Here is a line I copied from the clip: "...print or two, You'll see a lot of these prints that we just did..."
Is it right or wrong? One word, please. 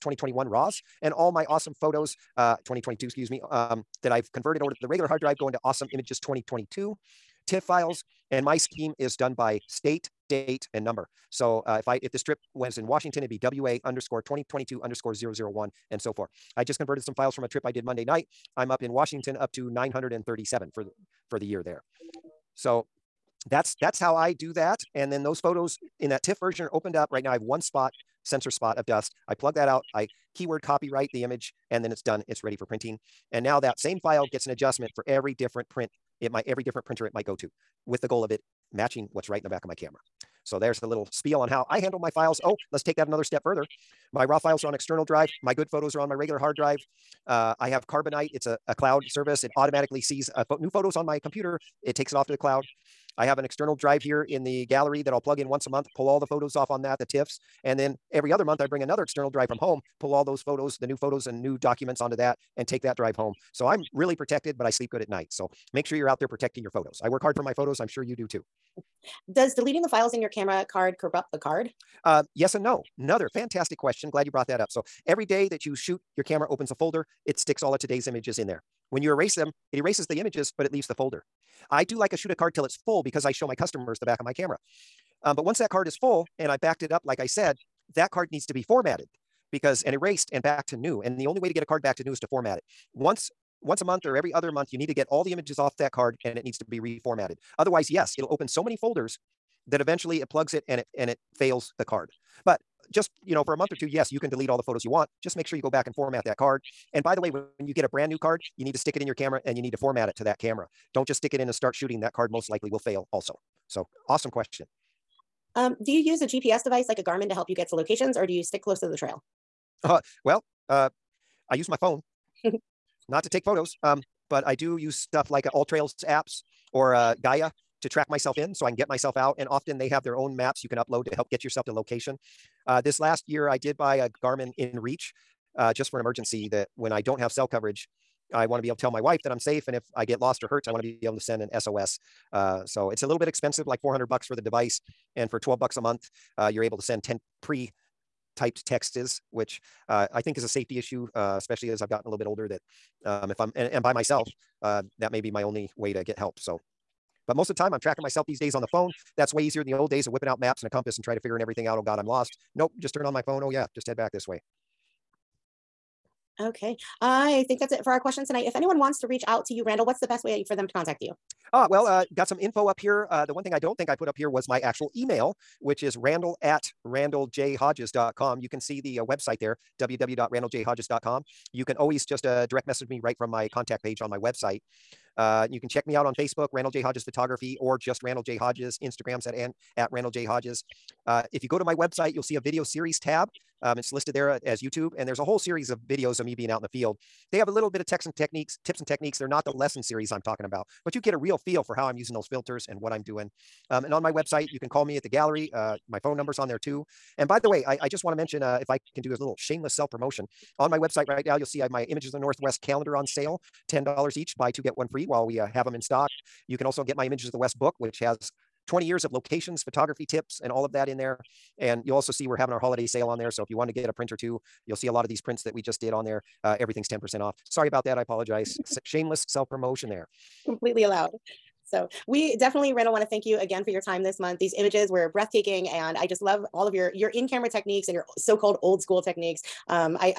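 right.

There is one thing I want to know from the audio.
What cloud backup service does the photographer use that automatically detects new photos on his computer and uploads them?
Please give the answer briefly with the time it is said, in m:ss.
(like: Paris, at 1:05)
Carbonite, at 0:47.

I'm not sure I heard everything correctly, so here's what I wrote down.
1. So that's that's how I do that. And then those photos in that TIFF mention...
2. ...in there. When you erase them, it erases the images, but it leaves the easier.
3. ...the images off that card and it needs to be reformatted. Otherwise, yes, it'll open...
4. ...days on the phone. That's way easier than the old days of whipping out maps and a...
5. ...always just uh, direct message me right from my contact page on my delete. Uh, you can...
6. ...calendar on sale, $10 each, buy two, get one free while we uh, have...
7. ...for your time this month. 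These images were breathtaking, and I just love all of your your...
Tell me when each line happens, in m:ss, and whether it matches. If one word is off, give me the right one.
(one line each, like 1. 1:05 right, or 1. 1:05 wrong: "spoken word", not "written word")
1. 0:22 wrong: "version", not "mention"
2. 1:18 wrong: "folder", not "easier"
3. 1:35 right
4. 2:38 right
5. 3:01 wrong: "website", not "delete"
6. 3:32 right
7. 3:53 right.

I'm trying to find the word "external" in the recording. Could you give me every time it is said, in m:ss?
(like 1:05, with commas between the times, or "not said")
0:44, 0:53, 0:59.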